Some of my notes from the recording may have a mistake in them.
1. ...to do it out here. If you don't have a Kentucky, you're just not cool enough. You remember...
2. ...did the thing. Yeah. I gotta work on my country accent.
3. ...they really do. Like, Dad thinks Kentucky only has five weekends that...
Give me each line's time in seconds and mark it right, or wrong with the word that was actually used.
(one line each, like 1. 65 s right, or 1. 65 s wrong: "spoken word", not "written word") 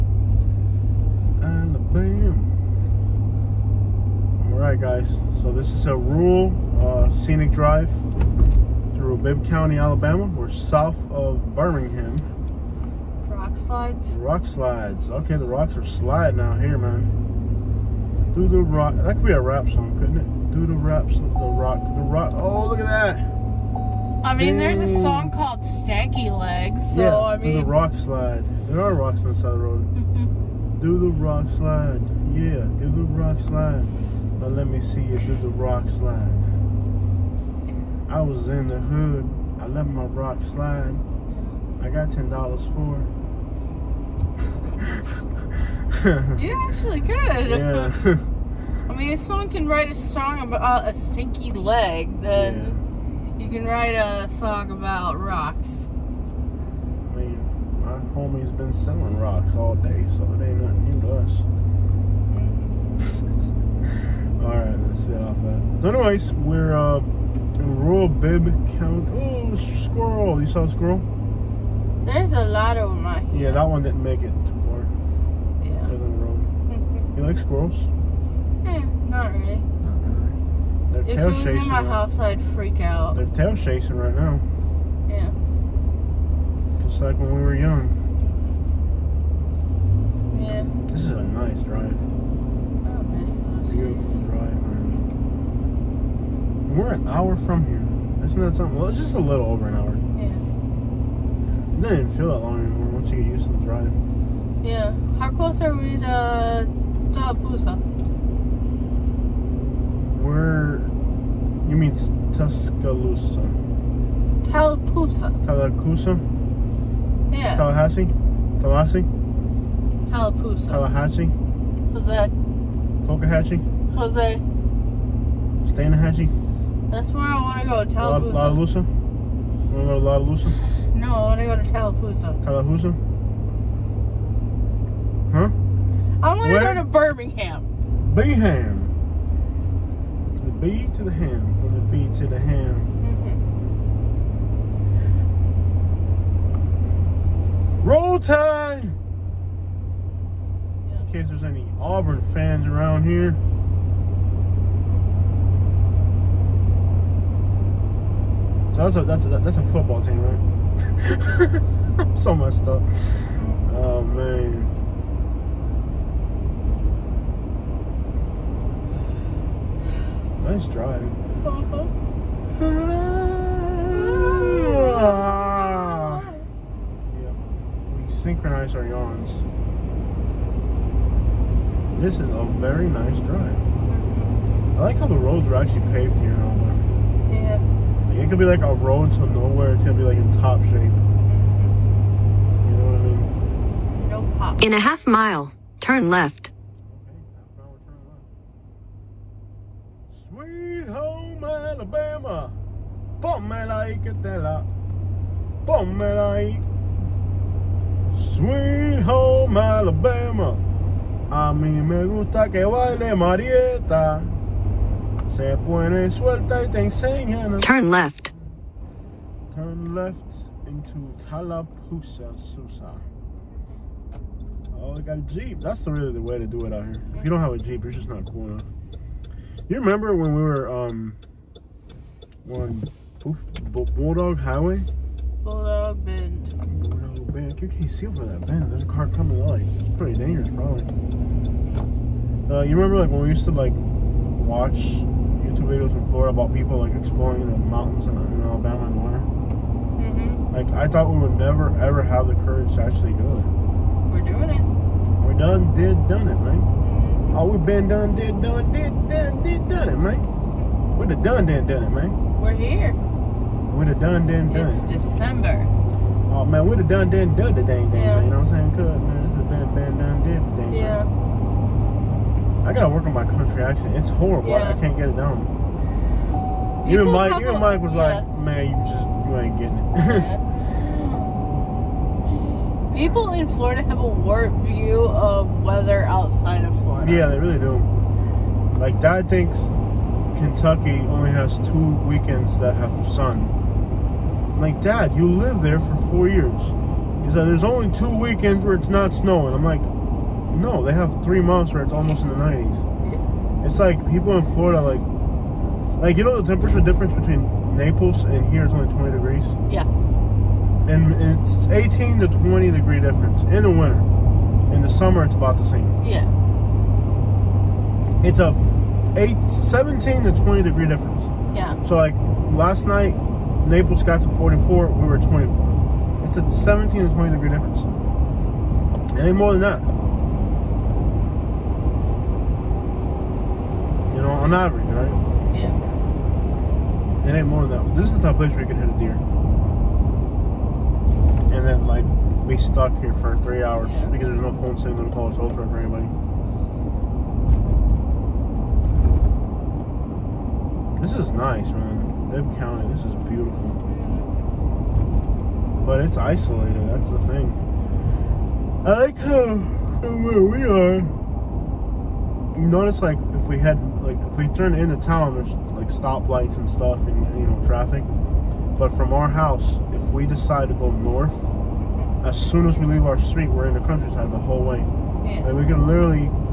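1. 226 s wrong: "Jeep", not "Kentucky"
2. 270 s right
3. 287 s wrong: "two", not "five".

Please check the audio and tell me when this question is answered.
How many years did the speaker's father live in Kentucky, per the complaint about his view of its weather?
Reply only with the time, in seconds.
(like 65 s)
296 s.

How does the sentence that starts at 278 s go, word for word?
like, man, you just you ain't getting it.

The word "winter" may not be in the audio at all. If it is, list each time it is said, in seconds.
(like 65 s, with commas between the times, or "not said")
248 s, 313 s.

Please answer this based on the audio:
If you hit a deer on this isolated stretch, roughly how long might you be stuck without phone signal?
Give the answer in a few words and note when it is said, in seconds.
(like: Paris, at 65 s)
3 hours, at 343 s.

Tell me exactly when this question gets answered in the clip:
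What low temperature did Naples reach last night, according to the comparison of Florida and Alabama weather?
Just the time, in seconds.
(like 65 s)
324 s.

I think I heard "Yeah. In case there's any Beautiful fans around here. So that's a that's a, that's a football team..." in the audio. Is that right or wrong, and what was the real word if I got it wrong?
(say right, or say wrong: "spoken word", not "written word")
wrong: "Auburn", not "Beautiful".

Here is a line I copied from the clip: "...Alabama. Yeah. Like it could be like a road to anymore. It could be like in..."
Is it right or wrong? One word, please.
wrong.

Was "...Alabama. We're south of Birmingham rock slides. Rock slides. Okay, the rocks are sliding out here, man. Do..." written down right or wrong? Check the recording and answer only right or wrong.
right.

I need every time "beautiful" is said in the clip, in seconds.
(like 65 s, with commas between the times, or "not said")
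93 s, 353 s.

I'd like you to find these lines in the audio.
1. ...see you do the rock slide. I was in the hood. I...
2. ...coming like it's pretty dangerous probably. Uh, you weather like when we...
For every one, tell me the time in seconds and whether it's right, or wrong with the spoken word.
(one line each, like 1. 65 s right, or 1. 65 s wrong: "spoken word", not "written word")
1. 34 s right
2. 239 s wrong: "remember", not "weather".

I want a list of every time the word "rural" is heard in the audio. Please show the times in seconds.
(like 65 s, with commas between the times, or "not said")
5 s, 67 s.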